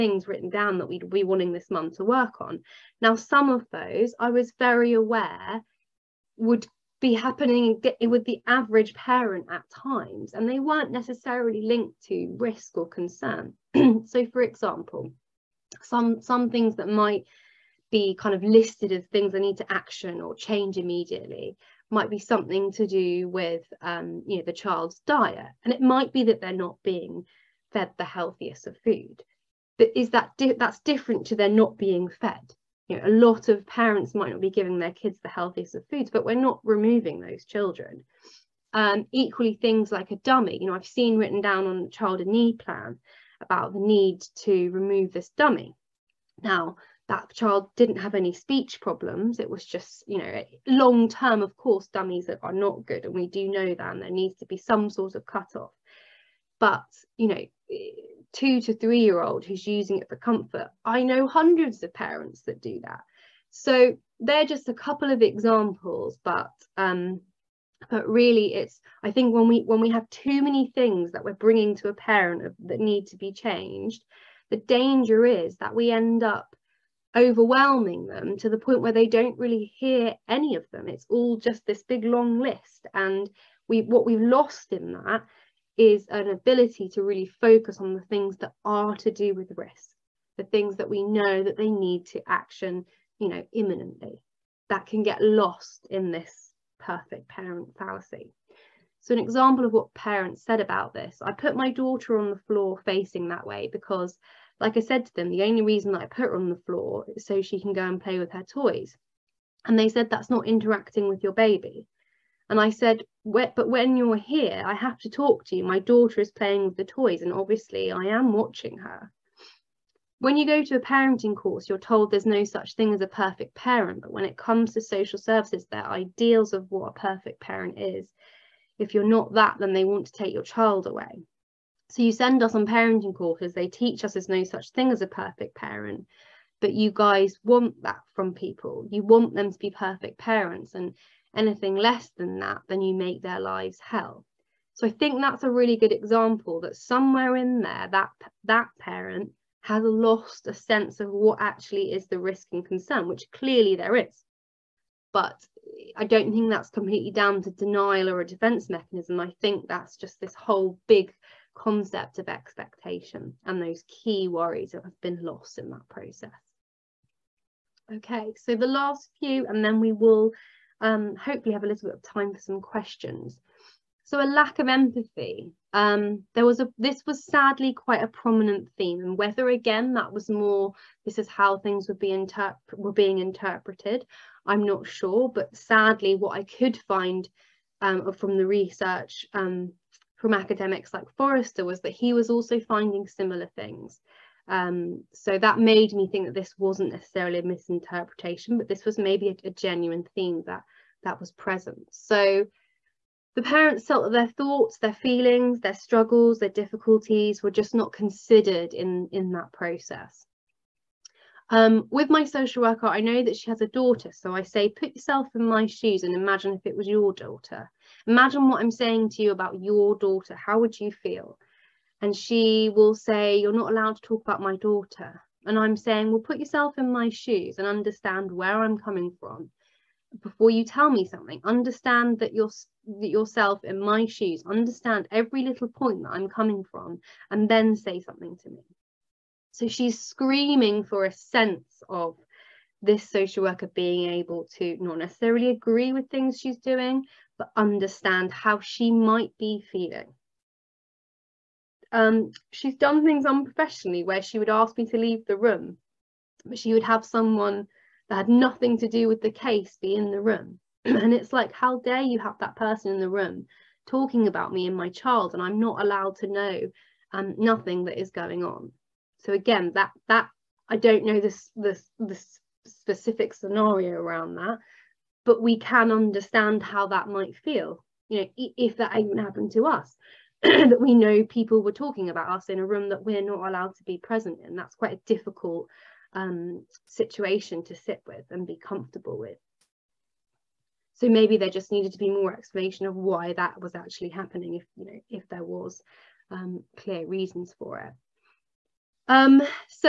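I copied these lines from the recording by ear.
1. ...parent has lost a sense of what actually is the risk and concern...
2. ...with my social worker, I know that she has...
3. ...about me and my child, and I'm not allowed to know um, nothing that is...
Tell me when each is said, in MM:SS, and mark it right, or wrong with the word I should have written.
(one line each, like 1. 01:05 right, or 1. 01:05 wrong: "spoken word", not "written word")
1. 02:28 right
2. 03:31 right
3. 04:24 right.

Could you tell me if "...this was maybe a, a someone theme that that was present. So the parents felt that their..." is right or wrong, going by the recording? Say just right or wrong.
wrong.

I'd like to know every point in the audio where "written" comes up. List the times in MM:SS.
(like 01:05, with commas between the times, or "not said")
00:00, 00:41.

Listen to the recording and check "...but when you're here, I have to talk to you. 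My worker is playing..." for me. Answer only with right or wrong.
wrong.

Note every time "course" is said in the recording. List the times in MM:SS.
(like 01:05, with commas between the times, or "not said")
00:51, 02:01, 02:13.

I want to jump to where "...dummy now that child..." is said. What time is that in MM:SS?
00:45.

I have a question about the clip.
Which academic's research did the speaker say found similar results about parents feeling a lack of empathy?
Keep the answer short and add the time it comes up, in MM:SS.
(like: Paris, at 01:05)
Forrester, at 03:11.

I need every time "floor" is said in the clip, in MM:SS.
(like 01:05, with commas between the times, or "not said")
01:42, 01:46.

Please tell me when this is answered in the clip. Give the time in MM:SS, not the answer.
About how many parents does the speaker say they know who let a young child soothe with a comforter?
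01:01.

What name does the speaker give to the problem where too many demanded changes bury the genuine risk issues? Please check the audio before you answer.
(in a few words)
Perfect parent fallacy.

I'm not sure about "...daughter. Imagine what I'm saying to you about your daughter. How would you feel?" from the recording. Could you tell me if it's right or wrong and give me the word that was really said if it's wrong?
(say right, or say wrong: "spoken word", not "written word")
right.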